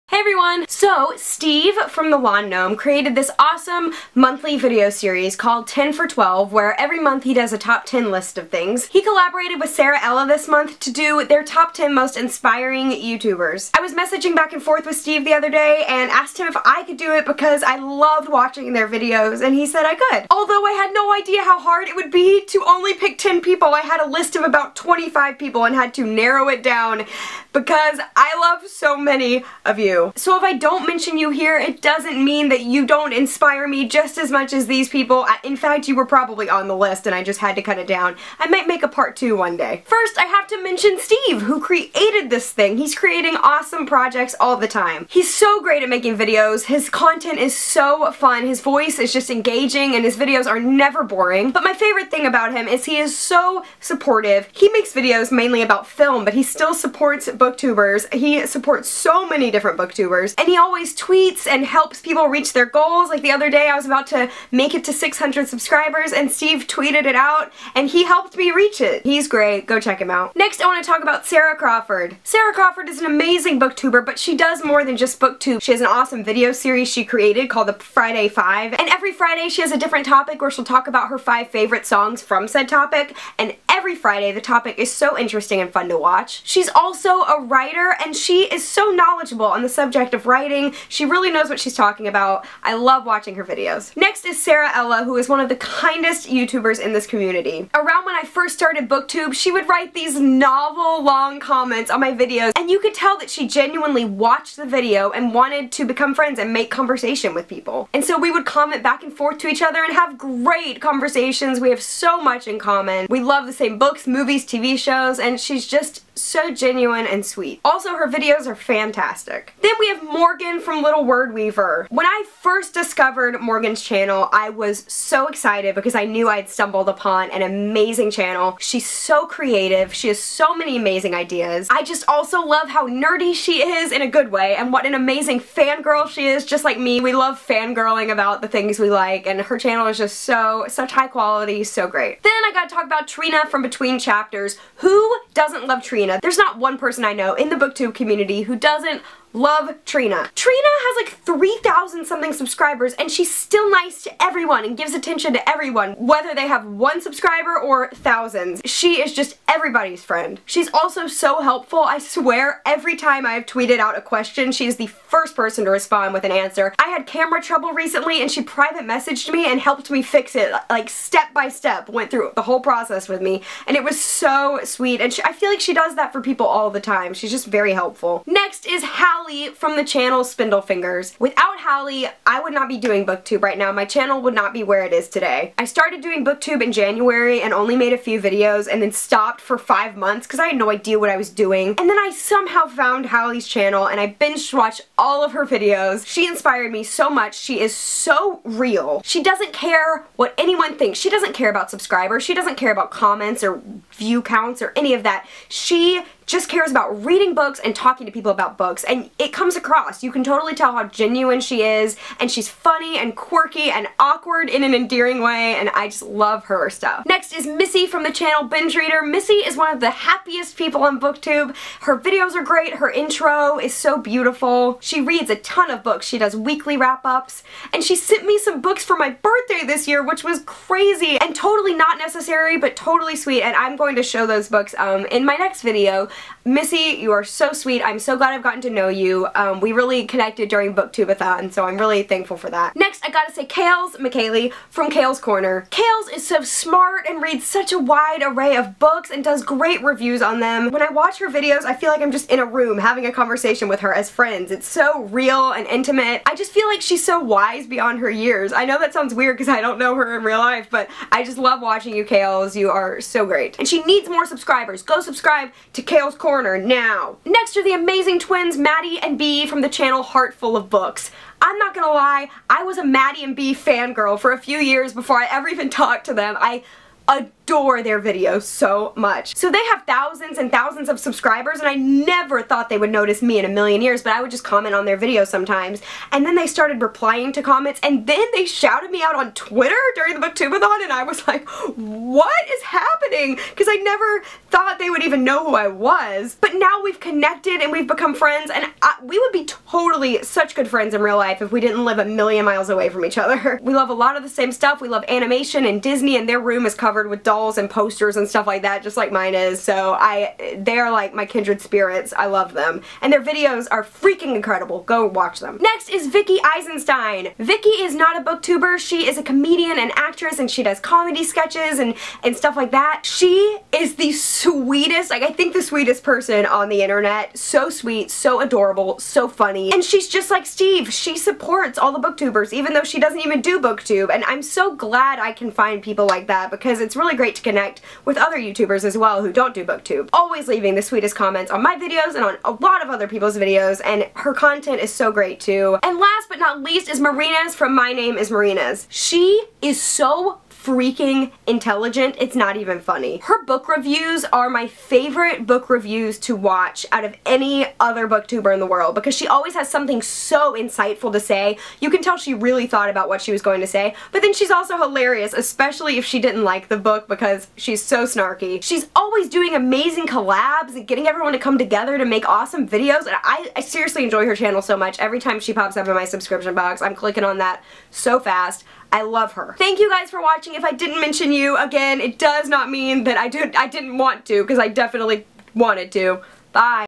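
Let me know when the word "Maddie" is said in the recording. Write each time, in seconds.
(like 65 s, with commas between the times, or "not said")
268 s, 272 s.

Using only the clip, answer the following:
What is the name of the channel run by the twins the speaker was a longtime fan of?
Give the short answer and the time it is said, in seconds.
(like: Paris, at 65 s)
Heart Full of Books, at 270 s.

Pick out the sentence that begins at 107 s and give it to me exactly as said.
And so we would comment back and forth to each other and have great conversations.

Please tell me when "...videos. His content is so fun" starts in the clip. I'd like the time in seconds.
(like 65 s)
46 s.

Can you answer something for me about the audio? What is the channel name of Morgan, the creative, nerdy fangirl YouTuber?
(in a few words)
Little Word Weaver.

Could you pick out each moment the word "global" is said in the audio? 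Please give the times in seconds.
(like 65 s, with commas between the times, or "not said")
not said.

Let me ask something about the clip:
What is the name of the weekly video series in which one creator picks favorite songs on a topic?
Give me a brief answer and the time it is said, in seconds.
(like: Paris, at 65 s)
Friday Five, at 77 s.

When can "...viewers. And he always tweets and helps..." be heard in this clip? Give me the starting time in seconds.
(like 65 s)
60 s.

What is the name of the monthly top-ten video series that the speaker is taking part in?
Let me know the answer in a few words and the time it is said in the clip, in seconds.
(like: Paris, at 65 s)
10 for 12, at 5 s.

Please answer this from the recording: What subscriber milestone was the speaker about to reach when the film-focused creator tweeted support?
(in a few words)
600.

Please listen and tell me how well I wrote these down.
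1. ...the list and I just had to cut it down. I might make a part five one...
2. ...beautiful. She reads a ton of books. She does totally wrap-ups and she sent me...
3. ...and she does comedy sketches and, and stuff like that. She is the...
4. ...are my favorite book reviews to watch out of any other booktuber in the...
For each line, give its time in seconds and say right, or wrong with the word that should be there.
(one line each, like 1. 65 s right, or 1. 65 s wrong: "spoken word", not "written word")
1. 36 s wrong: "two", not "five"
2. 223 s wrong: "weekly", not "totally"
3. 320 s right
4. 354 s right.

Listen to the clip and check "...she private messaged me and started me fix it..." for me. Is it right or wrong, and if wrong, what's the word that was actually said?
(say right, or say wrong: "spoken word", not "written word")
wrong: "helped", not "started".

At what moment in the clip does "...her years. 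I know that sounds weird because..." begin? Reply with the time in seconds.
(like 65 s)
257 s.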